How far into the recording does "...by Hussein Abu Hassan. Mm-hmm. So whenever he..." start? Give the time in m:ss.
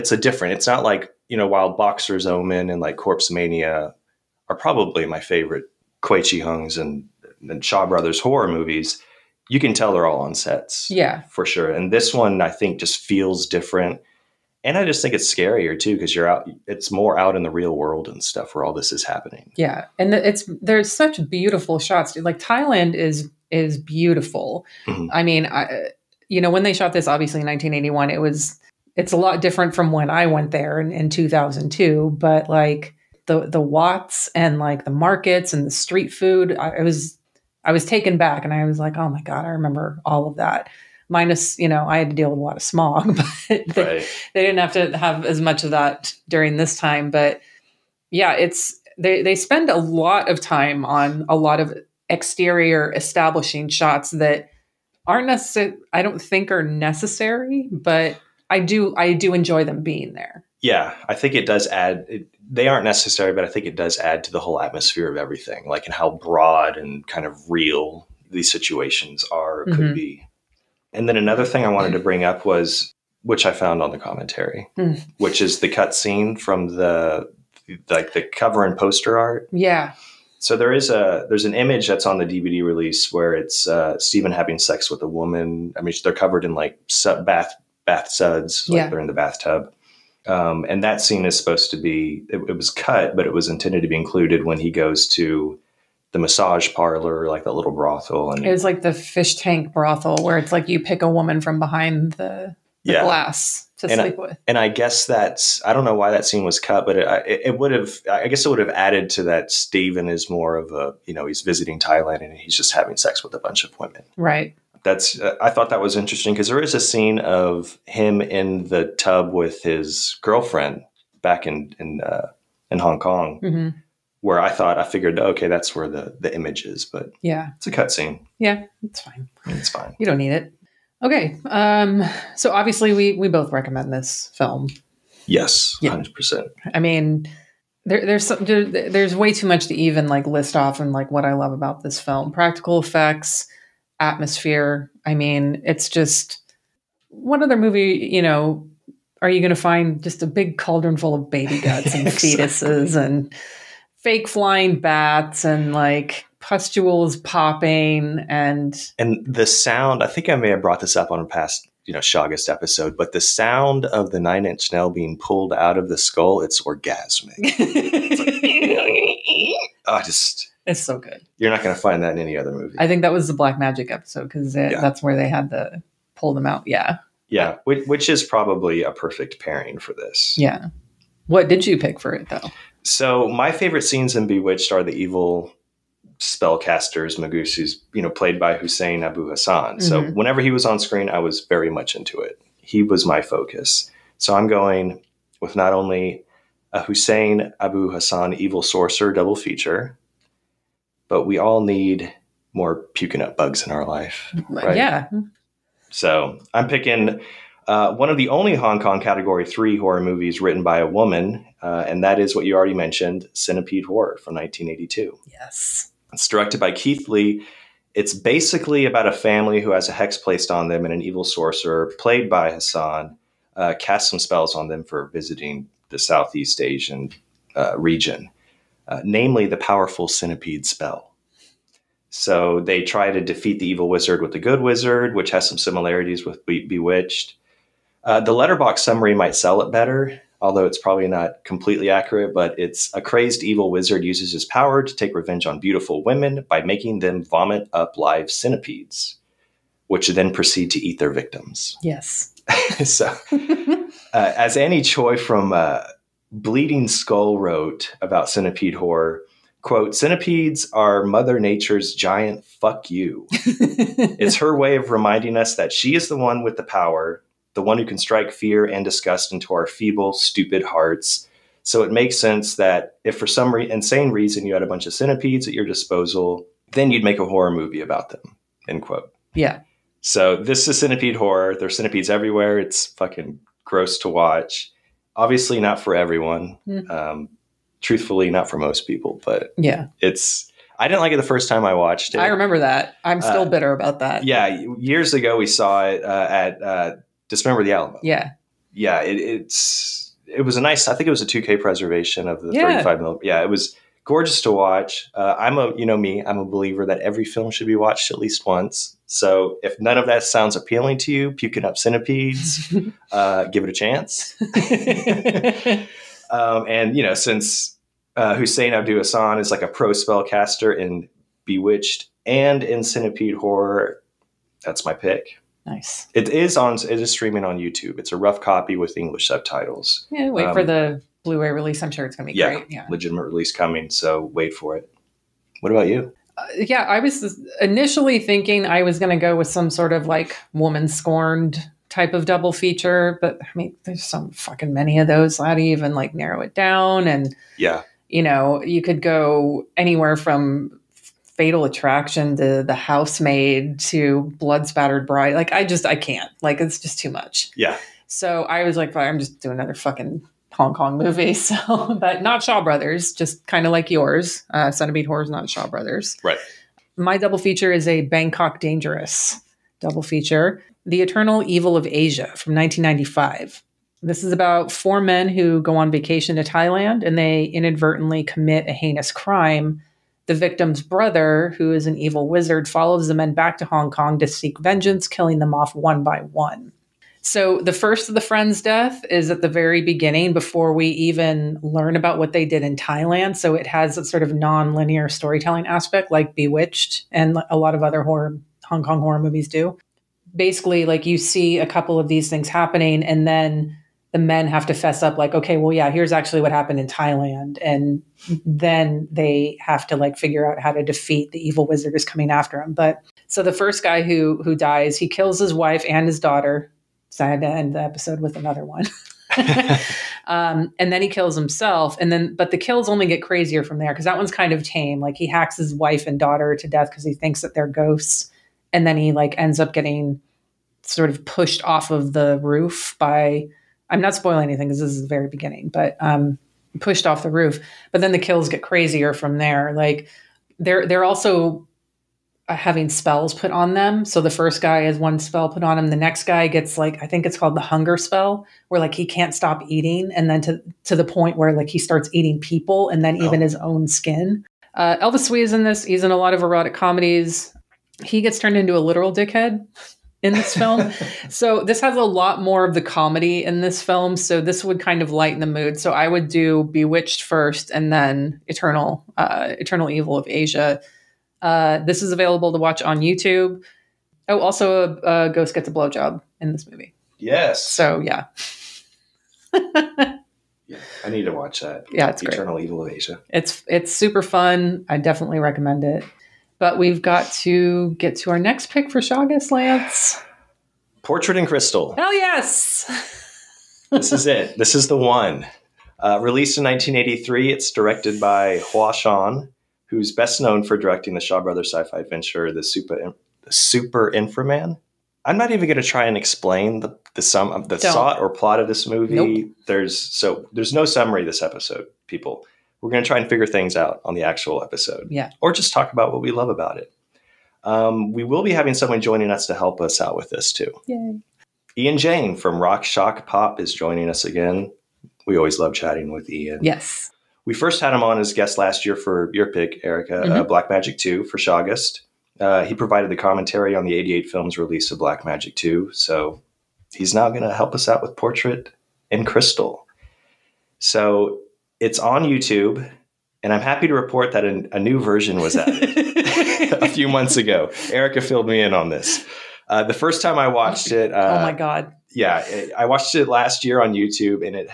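3:08.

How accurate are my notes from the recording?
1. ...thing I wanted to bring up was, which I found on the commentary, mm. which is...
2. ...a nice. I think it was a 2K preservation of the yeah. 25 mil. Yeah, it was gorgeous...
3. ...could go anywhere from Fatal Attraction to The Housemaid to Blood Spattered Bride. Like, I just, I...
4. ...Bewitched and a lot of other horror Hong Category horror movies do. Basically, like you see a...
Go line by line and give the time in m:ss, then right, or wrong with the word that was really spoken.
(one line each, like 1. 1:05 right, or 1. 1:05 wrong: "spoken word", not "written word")
1. 1:11 right
2. 5:00 wrong: "35", not "25"
3. 5:48 right
4. 6:36 wrong: "Kong", not "Category".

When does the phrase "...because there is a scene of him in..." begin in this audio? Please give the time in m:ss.
1:56.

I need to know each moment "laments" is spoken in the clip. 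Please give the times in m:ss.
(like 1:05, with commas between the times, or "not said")
not said.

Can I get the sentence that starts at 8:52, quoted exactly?
Uh, he provided the commentary on the 88 film's release of Black Magic 2.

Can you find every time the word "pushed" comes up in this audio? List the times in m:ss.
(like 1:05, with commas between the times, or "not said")
7:11, 7:16.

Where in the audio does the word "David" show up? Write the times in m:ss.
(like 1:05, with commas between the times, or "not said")
not said.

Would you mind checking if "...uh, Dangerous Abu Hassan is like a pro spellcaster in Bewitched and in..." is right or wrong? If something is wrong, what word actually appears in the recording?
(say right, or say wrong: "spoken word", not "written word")
wrong: "Hussein", not "Dangerous".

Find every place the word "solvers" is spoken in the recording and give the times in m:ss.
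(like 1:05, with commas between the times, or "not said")
not said.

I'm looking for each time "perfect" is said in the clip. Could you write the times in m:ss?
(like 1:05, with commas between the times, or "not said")
2:58.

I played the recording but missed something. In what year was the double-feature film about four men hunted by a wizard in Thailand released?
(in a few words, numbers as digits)
1995.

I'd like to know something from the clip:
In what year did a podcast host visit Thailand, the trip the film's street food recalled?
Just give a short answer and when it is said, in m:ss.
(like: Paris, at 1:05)
2002, at 0:31.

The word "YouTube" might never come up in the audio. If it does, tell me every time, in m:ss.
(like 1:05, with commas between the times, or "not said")
5:27, 7:52, 9:02, 9:13.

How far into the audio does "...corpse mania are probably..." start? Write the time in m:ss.
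0:02.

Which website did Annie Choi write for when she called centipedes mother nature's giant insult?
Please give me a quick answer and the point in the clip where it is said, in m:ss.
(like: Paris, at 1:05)
Bleeding Skull, at 4:16.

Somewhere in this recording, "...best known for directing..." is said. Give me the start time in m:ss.
8:20.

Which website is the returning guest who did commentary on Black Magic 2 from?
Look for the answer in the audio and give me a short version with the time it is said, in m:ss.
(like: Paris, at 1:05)
Rock Shock Pop, at 8:42.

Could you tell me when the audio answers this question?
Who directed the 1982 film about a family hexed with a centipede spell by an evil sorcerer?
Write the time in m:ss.
3:36.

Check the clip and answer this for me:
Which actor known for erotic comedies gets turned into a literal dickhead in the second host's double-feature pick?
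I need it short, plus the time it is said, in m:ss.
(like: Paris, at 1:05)
Elvis Tsui, at 7:34.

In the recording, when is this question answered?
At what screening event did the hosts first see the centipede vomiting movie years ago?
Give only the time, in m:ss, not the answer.
4:57.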